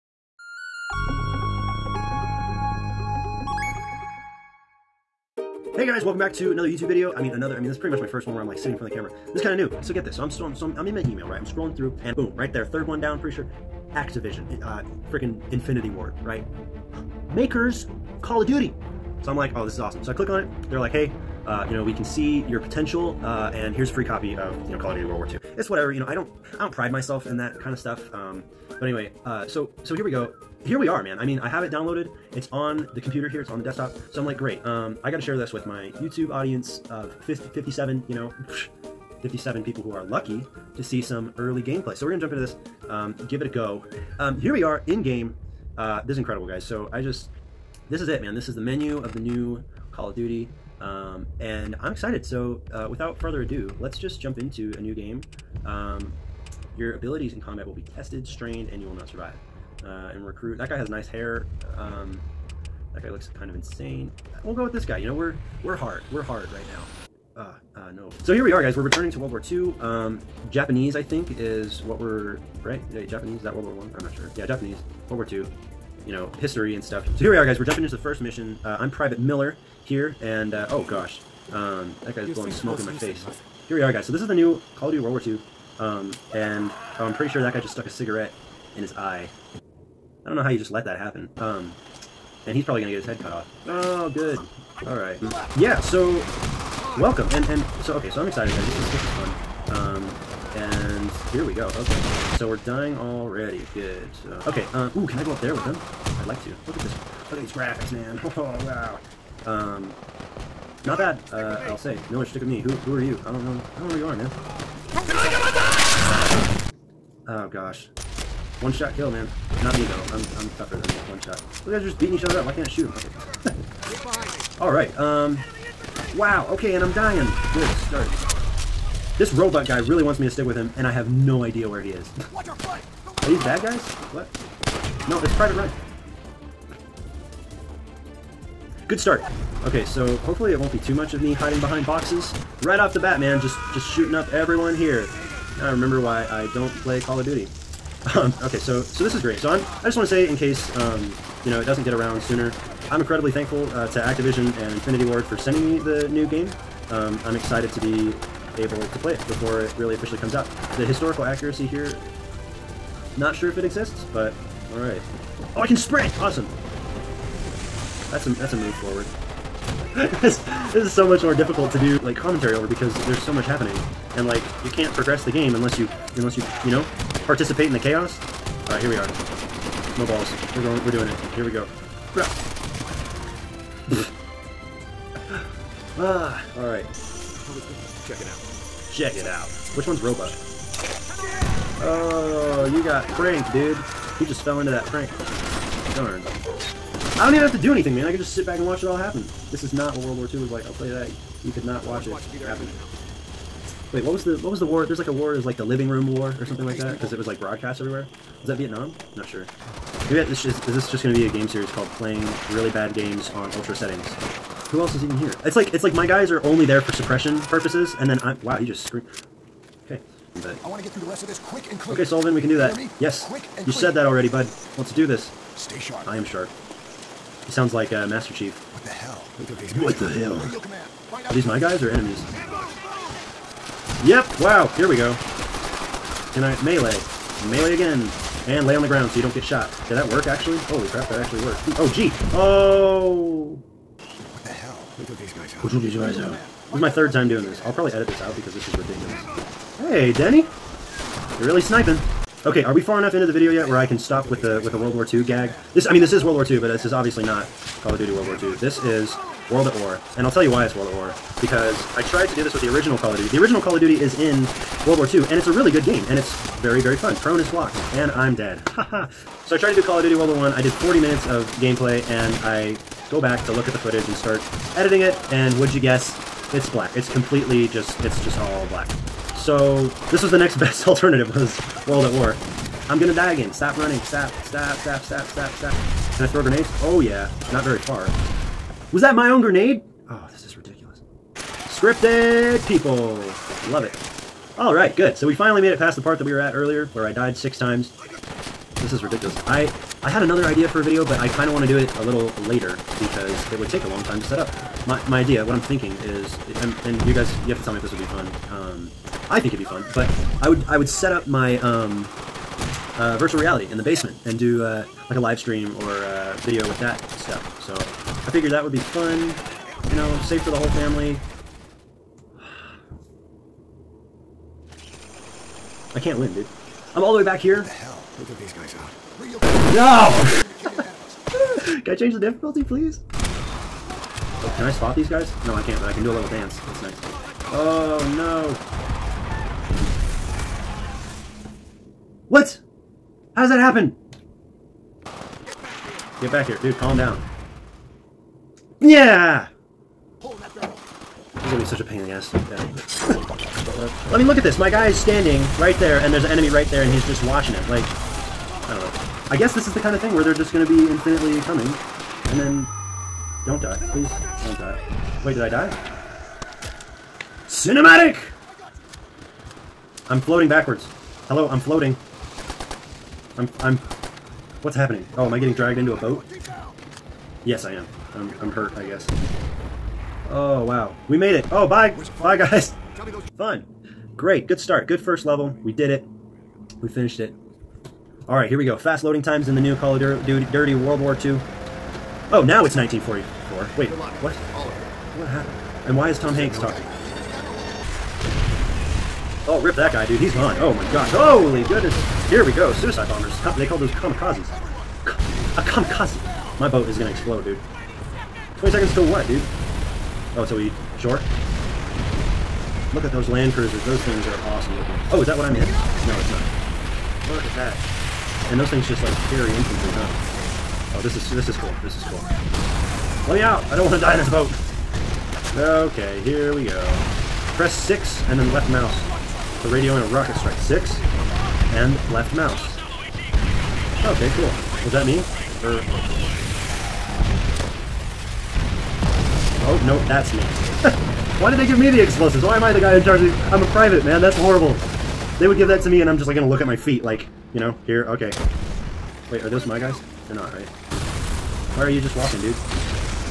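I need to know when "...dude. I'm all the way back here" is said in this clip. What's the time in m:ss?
5:26.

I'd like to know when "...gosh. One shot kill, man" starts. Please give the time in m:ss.
1:57.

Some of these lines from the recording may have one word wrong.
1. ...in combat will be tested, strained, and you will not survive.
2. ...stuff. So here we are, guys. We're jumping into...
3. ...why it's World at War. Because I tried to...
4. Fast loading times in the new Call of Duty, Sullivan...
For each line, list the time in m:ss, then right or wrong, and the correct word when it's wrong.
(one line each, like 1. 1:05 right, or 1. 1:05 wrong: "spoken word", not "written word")
1. 0:57 right
2. 1:16 right
3. 4:20 right
4. 6:28 wrong: "Dirty", not "Sullivan".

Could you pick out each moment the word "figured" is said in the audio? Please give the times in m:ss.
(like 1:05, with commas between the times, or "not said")
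5:18.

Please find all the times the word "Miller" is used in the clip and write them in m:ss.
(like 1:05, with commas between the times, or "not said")
1:19, 1:52.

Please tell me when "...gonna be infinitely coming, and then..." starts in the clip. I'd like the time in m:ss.
6:00.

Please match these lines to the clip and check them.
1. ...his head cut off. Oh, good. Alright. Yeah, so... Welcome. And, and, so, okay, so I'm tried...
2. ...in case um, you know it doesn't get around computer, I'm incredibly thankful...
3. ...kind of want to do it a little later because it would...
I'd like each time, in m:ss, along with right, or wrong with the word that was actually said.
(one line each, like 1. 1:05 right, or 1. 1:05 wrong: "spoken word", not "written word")
1. 1:33 wrong: "excited", not "tried"
2. 2:30 wrong: "sooner", not "computer"
3. 5:01 right.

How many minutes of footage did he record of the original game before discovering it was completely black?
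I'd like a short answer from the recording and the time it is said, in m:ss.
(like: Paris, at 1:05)
40, at 4:30.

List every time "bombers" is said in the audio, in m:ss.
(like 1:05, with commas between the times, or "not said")
6:43.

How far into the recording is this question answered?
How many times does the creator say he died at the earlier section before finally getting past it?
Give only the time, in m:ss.
4:57.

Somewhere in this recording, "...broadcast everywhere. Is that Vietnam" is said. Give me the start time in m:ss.
3:27.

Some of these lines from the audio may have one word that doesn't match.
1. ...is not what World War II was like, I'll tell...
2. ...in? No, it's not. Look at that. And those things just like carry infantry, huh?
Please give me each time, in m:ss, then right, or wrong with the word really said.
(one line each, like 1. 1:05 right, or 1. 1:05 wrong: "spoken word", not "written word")
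1. 3:19 right
2. 6:55 right.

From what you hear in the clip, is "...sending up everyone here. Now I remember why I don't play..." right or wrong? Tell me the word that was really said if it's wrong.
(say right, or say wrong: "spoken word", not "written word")
wrong: "shooting", not "sending".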